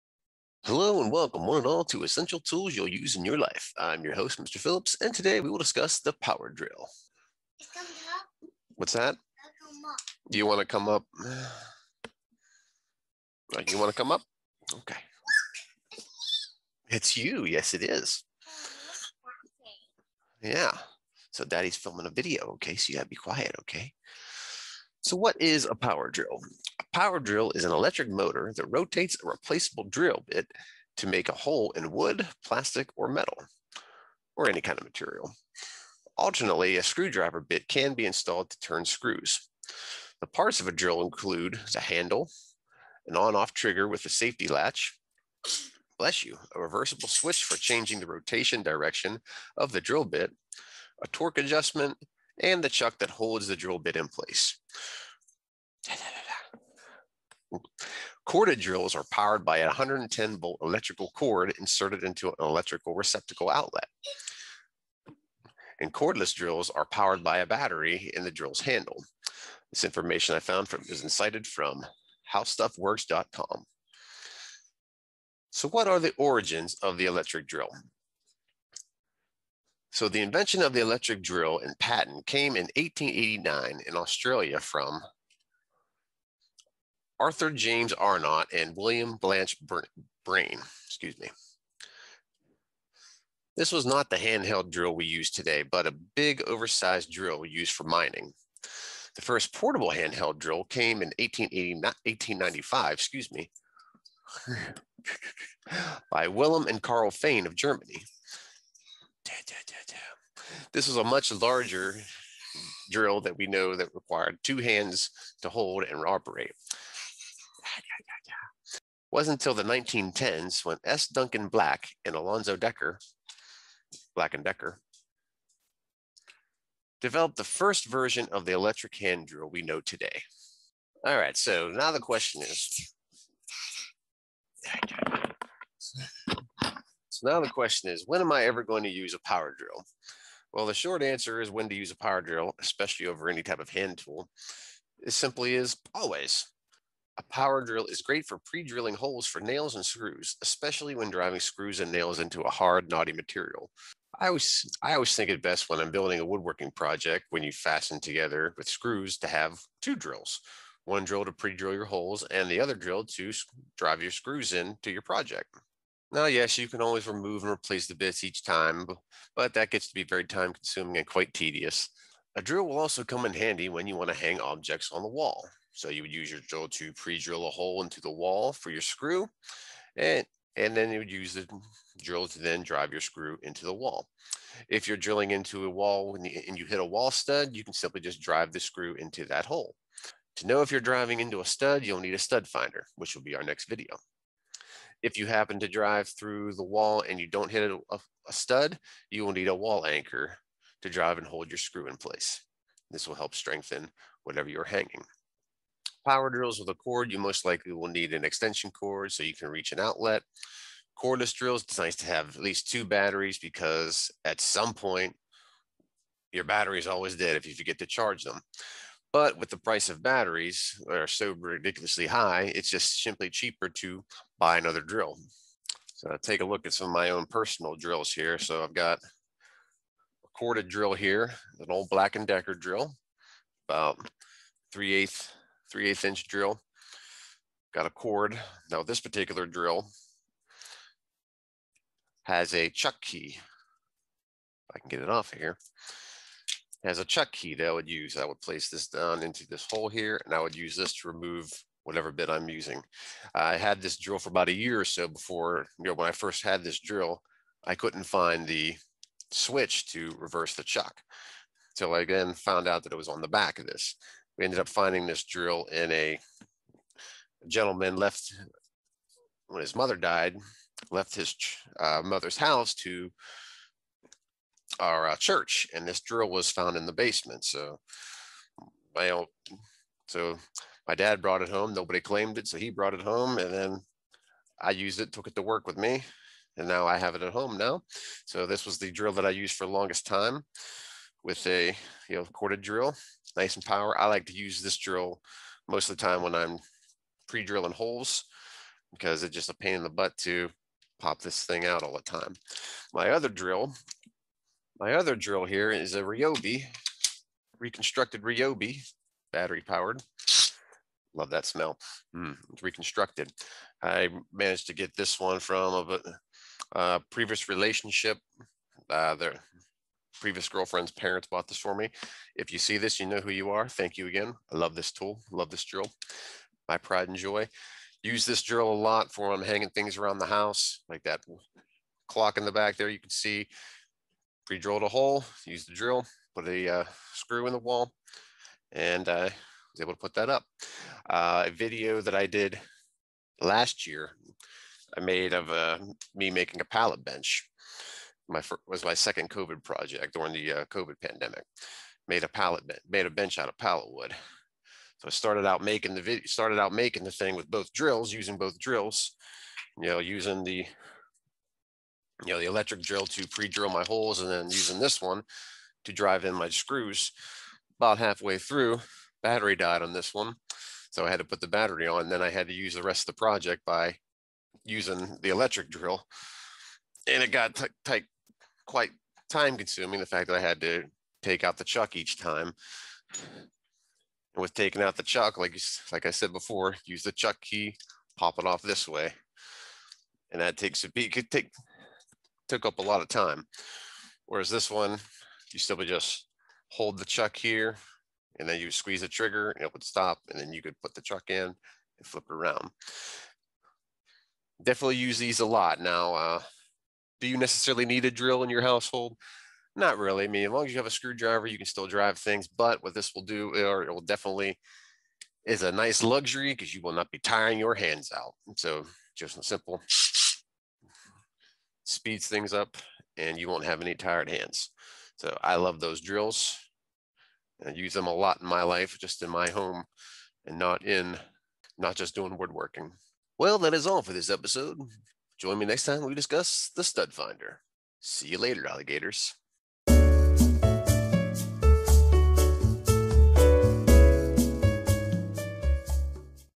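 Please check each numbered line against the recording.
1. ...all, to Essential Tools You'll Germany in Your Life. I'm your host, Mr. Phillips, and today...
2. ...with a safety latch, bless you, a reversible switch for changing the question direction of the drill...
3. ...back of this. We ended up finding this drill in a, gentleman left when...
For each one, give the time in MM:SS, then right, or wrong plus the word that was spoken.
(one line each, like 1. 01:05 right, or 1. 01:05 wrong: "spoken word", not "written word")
1. 00:01 wrong: "Use", not "Germany"
2. 00:43 wrong: "rotation", not "question"
3. 04:23 right.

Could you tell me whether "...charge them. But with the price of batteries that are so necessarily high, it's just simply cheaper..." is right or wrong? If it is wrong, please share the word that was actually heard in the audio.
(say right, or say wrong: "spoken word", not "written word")
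wrong: "ridiculously", not "necessarily".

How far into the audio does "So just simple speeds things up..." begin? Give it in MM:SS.
06:58.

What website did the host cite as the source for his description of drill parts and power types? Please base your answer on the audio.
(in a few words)
howstuffworks.com.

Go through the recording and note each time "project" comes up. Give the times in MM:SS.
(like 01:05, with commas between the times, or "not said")
02:36, 02:45, 05:49, 06:13.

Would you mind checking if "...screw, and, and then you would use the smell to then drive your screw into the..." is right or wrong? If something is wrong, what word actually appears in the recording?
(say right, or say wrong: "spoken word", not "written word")
wrong: "drill", not "smell".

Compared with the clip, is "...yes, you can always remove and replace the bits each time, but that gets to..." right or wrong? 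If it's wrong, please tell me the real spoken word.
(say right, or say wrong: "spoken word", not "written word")
right.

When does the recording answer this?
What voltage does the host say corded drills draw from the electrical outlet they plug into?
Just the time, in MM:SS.
00:59.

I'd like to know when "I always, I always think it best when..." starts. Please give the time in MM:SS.
02:34.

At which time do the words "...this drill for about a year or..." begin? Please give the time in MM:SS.
04:13.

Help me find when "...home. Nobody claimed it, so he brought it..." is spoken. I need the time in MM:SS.
04:41.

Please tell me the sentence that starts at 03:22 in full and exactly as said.
This will help strengthen whatever you're hanging.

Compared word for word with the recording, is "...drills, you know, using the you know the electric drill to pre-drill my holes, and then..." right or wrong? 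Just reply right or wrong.
right.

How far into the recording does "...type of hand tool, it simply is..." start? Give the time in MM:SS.
02:23.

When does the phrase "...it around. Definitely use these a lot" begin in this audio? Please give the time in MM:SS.
06:42.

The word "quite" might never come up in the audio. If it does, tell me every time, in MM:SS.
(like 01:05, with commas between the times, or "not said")
02:51, 06:18.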